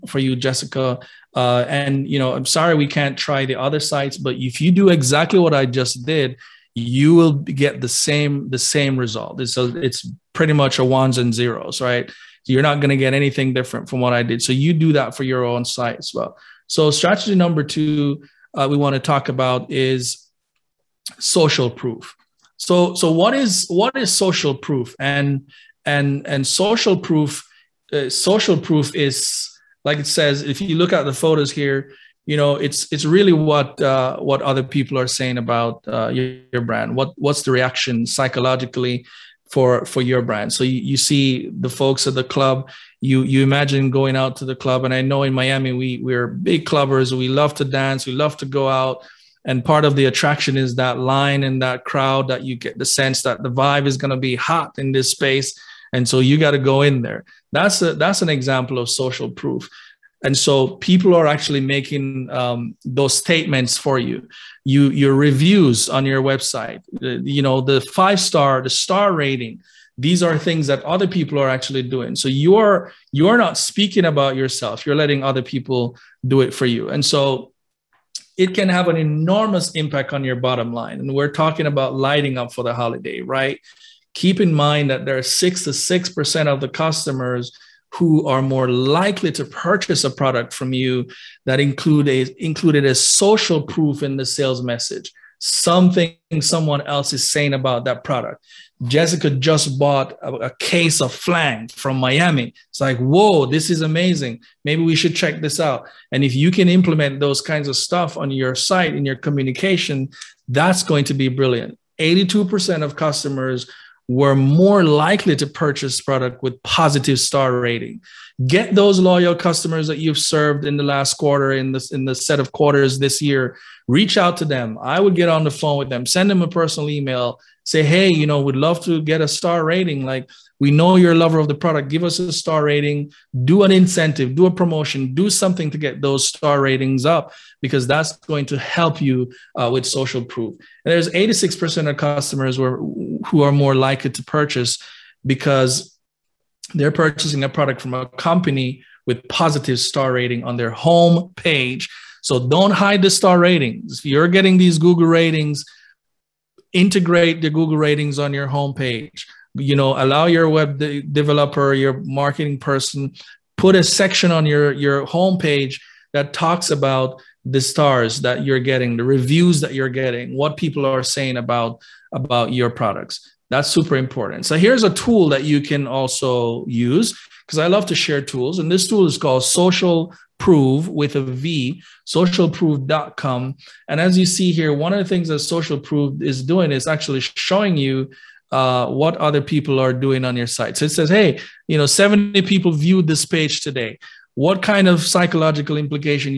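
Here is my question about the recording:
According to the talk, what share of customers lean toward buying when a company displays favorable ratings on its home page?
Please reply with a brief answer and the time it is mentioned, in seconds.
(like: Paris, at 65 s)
86%, at 141 s.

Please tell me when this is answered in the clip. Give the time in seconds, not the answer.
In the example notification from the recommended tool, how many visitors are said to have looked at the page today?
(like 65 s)
191 s.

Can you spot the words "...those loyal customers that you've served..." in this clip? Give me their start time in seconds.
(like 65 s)
118 s.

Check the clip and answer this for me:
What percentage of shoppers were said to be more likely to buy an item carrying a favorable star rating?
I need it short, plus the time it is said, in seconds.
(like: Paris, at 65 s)
82%, at 111 s.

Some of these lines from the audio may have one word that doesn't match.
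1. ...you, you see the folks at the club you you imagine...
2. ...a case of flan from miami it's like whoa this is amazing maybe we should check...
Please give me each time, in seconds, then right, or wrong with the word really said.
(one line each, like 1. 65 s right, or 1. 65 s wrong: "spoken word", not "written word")
1. 40 s right
2. 100 s right.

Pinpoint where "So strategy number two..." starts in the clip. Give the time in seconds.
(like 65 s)
16 s.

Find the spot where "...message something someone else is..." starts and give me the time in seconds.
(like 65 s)
94 s.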